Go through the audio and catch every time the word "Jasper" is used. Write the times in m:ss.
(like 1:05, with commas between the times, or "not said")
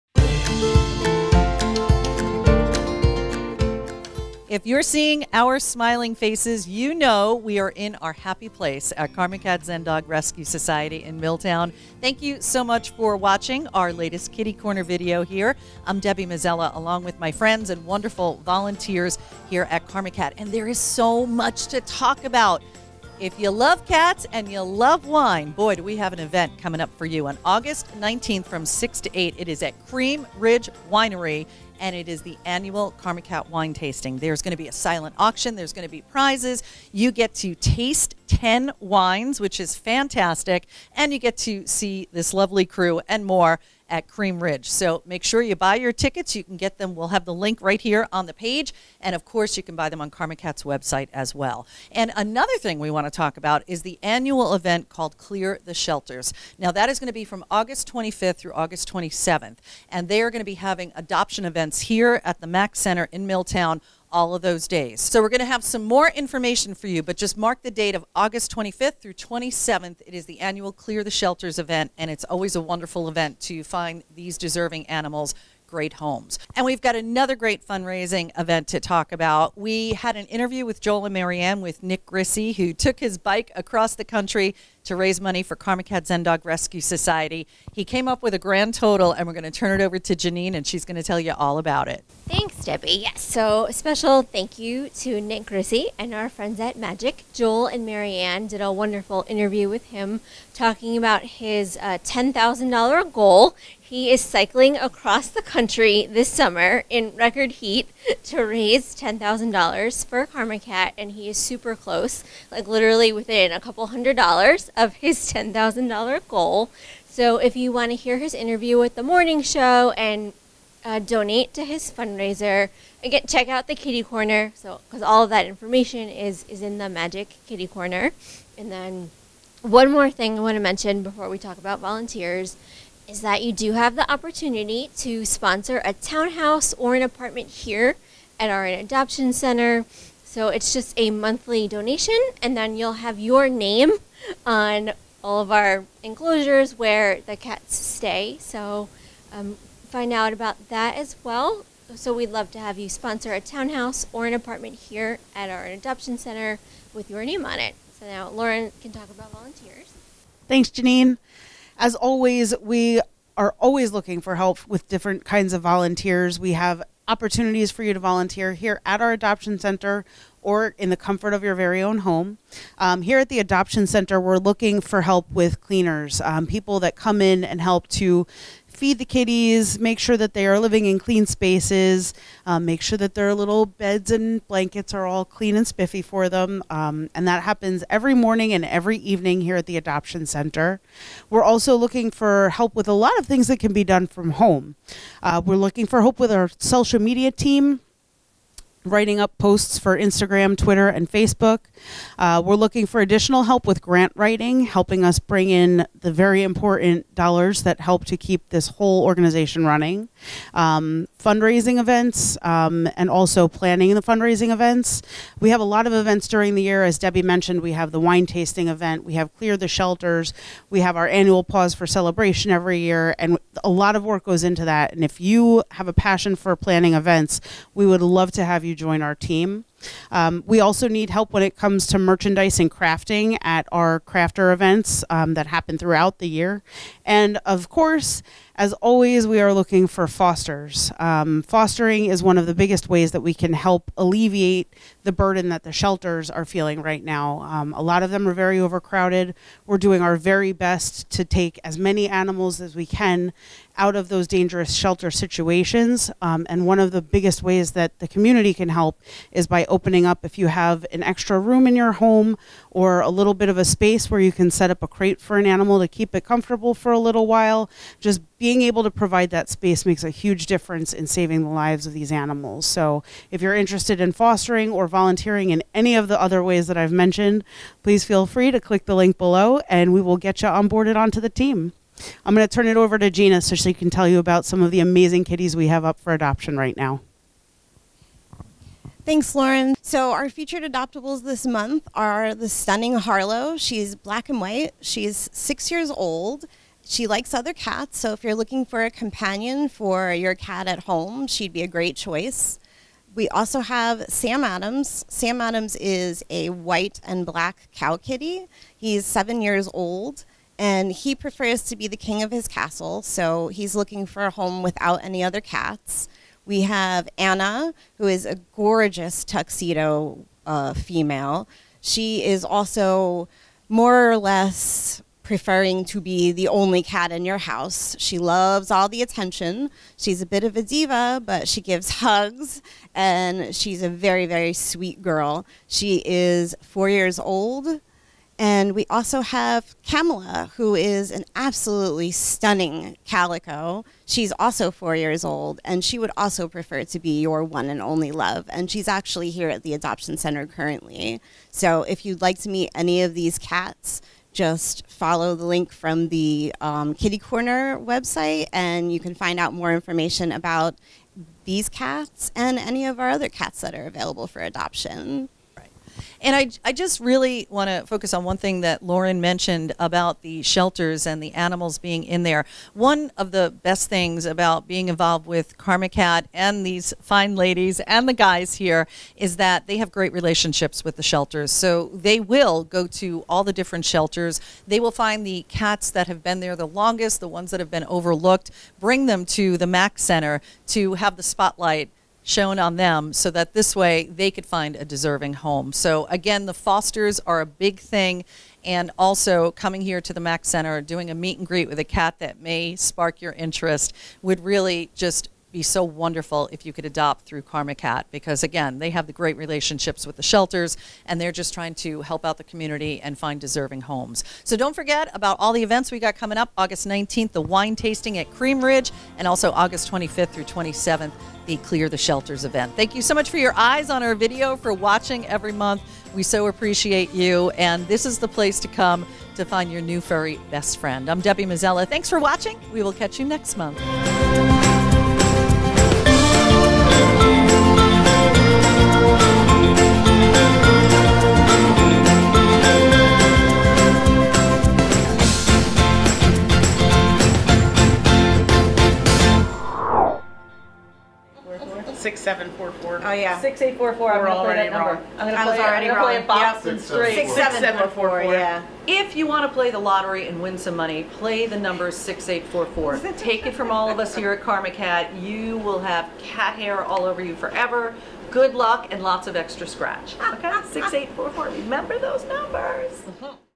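not said.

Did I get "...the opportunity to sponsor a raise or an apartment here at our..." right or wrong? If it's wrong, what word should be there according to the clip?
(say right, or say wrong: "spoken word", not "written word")
wrong: "townhouse", not "raise".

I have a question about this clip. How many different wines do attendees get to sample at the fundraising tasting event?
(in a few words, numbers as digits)
10.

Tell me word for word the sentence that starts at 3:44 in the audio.
And if you have a passion for planning events, we would love to have you you join our team.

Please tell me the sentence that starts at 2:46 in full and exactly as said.
We have opportunities for you to volunteer here at our adoption center or in the comfort of your very own home.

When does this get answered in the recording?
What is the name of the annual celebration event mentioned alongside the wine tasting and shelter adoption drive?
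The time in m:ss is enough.
3:41.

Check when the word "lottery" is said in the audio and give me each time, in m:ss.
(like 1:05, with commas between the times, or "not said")
7:39.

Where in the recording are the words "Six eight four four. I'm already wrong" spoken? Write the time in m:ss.
7:33.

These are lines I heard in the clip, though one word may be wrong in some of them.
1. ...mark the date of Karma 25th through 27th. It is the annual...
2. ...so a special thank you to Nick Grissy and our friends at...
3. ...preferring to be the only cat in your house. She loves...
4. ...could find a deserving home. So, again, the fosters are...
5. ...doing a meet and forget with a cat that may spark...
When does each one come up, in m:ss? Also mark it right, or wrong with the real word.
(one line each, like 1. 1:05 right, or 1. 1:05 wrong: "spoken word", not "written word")
1. 1:07 wrong: "August", not "Karma"
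2. 1:33 right
3. 5:25 right
4. 6:34 right
5. 6:40 wrong: "greet", not "forget".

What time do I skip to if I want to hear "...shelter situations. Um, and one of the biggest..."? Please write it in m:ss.
4:14.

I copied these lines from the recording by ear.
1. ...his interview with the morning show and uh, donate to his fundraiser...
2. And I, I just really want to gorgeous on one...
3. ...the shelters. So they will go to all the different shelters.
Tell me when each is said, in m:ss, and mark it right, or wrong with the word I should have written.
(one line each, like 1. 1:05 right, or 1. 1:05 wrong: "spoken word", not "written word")
1. 1:58 right
2. 6:06 wrong: "focus", not "gorgeous"
3. 6:20 right.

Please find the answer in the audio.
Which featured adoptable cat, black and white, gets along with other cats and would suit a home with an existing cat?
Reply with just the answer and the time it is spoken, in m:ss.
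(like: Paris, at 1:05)
Harlow, at 4:52.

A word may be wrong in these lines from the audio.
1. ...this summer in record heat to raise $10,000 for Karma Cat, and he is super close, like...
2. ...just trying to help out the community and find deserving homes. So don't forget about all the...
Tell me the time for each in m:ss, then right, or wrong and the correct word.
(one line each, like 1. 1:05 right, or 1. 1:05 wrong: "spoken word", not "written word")
1. 1:46 right
2. 6:51 right.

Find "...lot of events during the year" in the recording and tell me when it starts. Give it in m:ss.
3:35.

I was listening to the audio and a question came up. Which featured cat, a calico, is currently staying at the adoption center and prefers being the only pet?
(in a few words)
Kamala.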